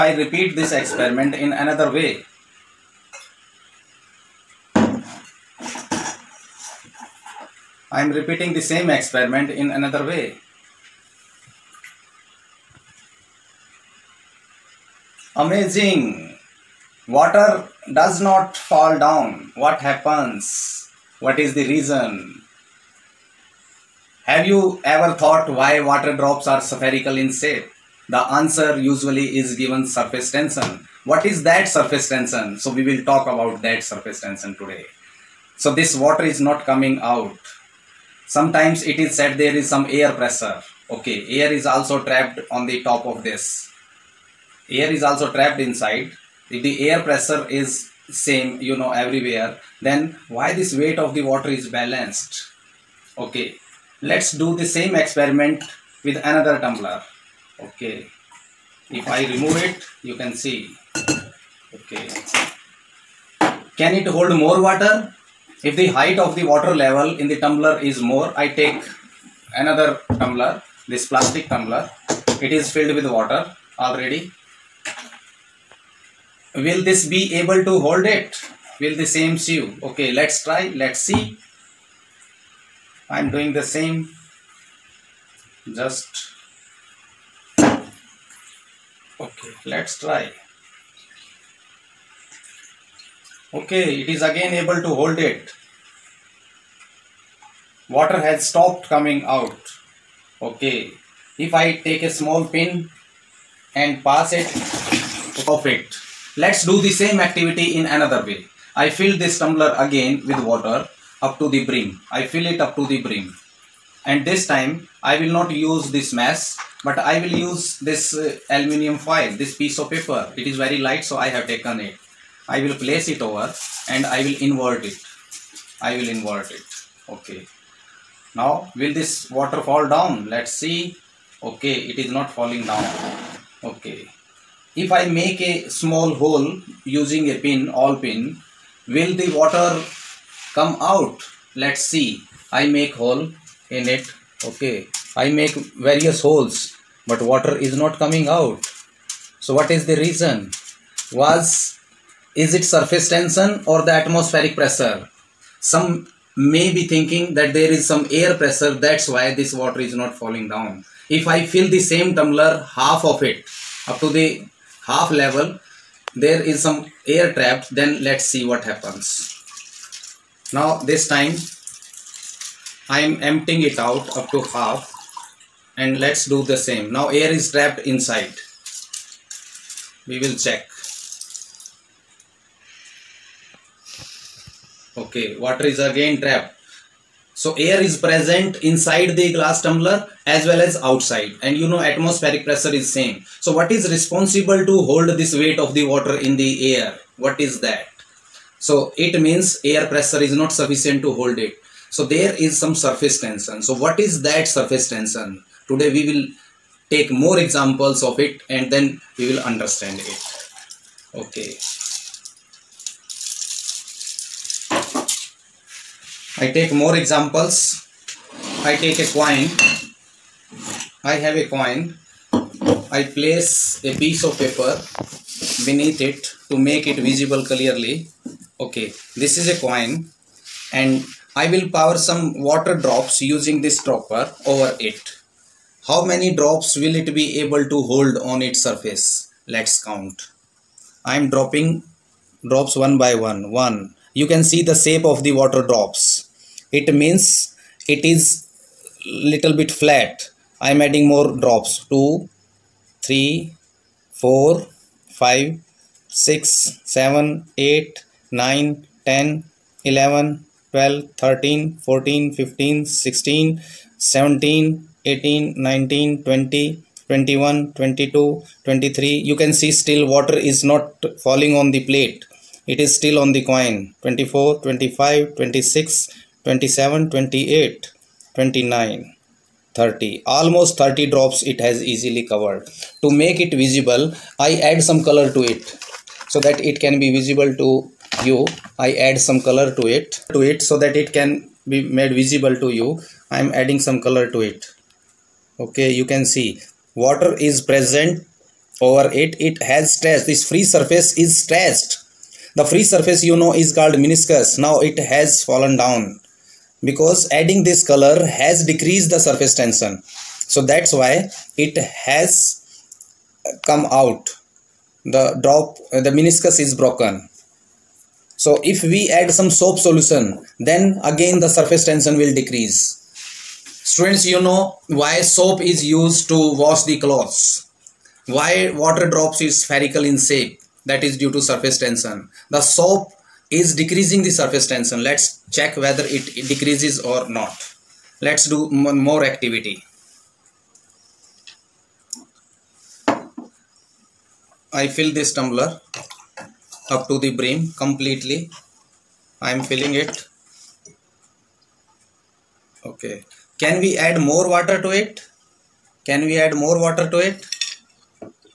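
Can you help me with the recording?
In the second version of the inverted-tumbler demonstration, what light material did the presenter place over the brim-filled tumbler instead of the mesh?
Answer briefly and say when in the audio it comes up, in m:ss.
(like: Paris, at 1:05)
aluminium foil, at 1:58.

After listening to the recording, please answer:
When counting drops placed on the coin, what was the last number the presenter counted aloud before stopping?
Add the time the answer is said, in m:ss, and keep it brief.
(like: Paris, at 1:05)
8, at 4:17.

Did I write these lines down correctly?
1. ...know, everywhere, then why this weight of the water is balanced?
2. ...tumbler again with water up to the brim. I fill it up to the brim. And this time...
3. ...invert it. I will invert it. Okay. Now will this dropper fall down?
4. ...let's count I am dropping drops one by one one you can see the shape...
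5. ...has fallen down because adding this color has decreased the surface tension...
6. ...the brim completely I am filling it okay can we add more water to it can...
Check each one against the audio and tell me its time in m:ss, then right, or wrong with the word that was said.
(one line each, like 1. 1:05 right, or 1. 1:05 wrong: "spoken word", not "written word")
1. 0:48 right
2. 1:49 right
3. 2:04 wrong: "water", not "dropper"
4. 3:59 right
5. 5:05 right
6. 5:47 right.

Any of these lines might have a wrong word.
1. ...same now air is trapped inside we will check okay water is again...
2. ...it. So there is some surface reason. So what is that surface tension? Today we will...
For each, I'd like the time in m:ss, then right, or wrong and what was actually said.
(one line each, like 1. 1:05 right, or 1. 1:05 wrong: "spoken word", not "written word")
1. 2:56 right
2. 3:21 wrong: "tension", not "reason".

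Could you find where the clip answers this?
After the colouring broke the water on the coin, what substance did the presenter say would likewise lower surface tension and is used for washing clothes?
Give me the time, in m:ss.
5:19.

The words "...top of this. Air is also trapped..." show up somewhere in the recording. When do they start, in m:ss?
0:42.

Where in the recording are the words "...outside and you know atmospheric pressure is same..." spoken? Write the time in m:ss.
3:10.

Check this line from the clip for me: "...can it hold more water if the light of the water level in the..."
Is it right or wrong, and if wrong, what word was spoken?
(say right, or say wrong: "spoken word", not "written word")
wrong: "height", not "light".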